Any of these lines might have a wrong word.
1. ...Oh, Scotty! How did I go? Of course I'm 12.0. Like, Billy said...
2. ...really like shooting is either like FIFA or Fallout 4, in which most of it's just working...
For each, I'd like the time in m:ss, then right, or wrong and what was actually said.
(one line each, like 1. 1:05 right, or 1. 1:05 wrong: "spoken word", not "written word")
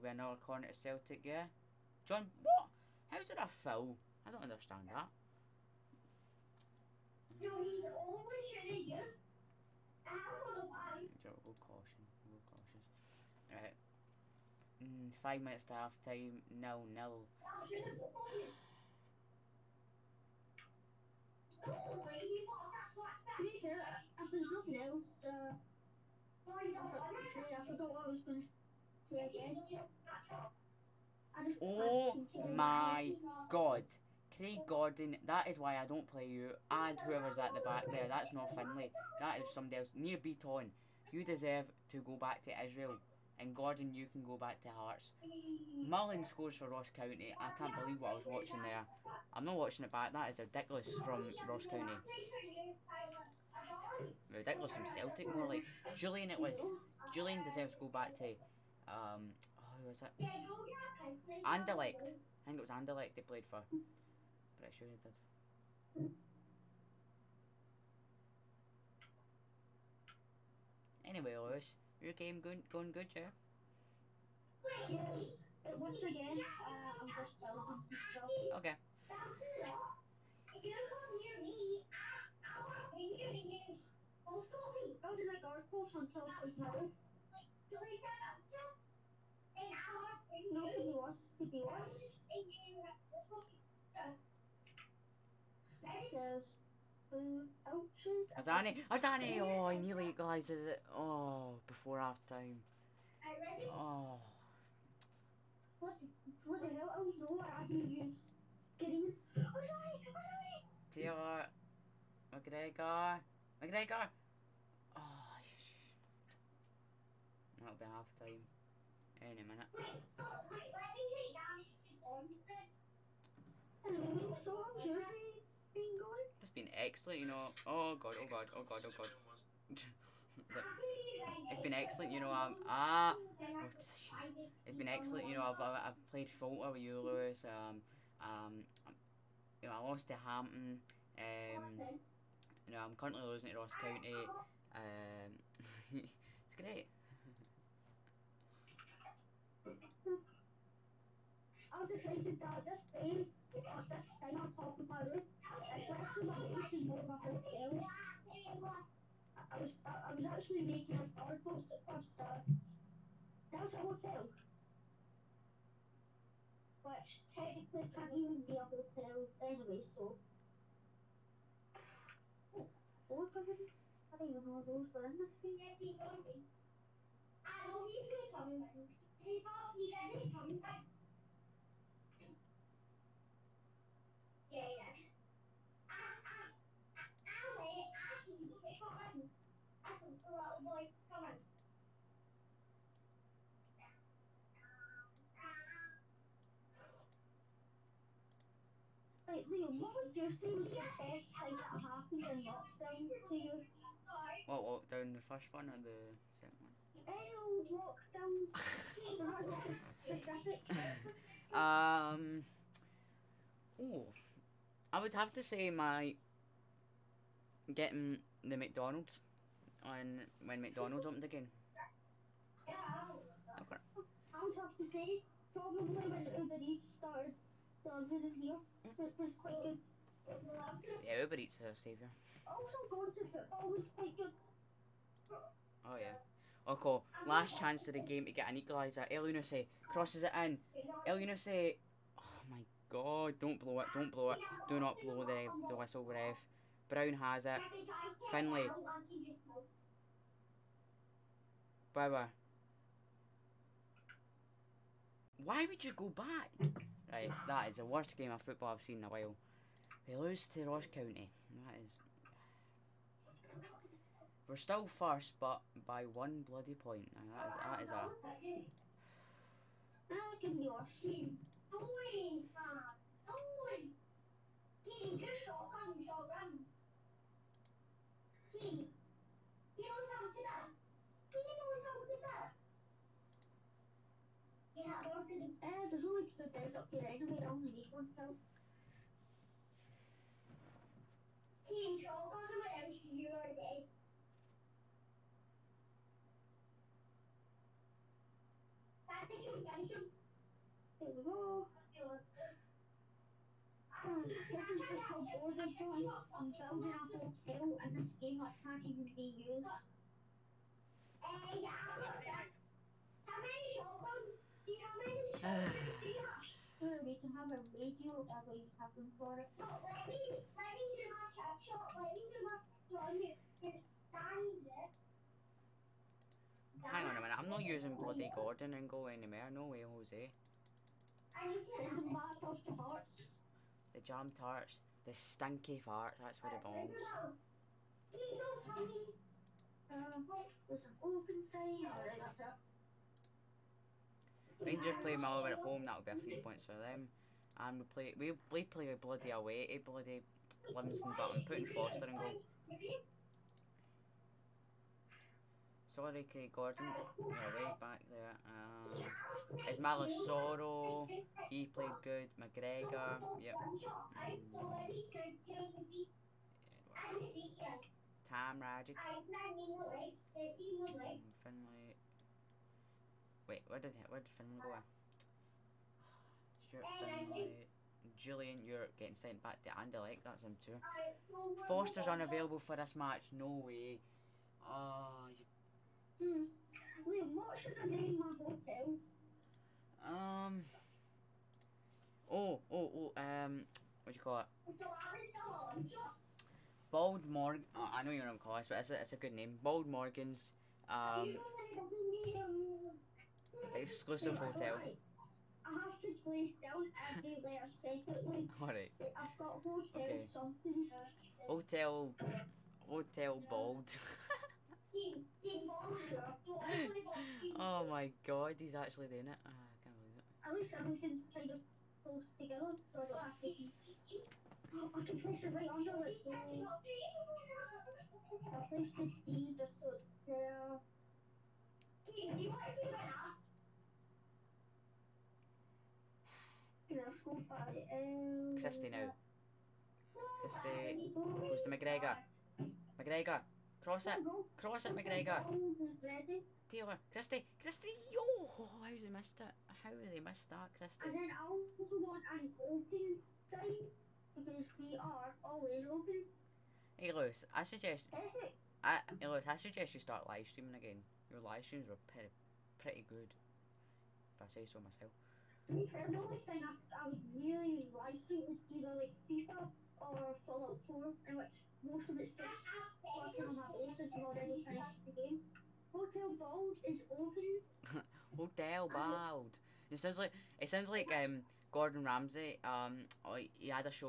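1. 1:24 right
2. 7:47 right.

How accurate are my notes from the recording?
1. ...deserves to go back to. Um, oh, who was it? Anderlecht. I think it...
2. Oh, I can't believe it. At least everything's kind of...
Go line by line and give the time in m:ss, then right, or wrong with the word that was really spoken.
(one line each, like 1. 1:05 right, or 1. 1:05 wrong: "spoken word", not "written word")
1. 0:57 right
2. 6:59 right.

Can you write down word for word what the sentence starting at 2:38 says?
I, was, I, was actually making an article at first.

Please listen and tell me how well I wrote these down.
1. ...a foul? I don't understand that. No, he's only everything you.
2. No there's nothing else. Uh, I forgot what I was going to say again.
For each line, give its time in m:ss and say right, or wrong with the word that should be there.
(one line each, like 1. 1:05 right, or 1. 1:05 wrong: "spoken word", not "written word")
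1. 0:03 wrong: "shooting", not "everything"
2. 0:21 right.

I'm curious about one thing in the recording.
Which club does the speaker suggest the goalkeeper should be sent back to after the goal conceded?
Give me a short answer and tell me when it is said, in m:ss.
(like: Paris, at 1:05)
Hearts, at 0:44.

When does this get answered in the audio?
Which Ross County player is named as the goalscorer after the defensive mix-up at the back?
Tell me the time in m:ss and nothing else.
0:45.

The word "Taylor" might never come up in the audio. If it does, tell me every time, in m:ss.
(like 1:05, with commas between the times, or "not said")
1:51, 7:26.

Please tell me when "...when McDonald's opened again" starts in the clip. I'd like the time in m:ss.
3:40.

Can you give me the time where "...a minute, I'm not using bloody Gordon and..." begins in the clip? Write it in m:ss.
5:27.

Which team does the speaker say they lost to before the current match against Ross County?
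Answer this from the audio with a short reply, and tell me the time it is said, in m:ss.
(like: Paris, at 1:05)
Hampton, at 2:20.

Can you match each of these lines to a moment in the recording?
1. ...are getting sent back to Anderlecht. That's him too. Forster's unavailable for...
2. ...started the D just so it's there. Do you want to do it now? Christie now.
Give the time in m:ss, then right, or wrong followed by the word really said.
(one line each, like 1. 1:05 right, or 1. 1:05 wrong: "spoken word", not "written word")
1. 6:18 right
2. 7:08 wrong: "placed", not "started".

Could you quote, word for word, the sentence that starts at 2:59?
He's not, he's going to come back.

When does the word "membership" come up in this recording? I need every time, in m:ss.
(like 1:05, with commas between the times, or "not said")
not said.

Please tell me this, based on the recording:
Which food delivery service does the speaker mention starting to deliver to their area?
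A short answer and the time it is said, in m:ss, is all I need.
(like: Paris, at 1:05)
Uber Eats, at 3:46.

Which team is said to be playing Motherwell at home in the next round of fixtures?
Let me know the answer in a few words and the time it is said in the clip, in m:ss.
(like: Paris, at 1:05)
Rangers, at 5:44.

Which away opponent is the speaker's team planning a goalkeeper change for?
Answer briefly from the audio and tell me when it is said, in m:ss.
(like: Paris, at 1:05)
Livingston, at 5:50.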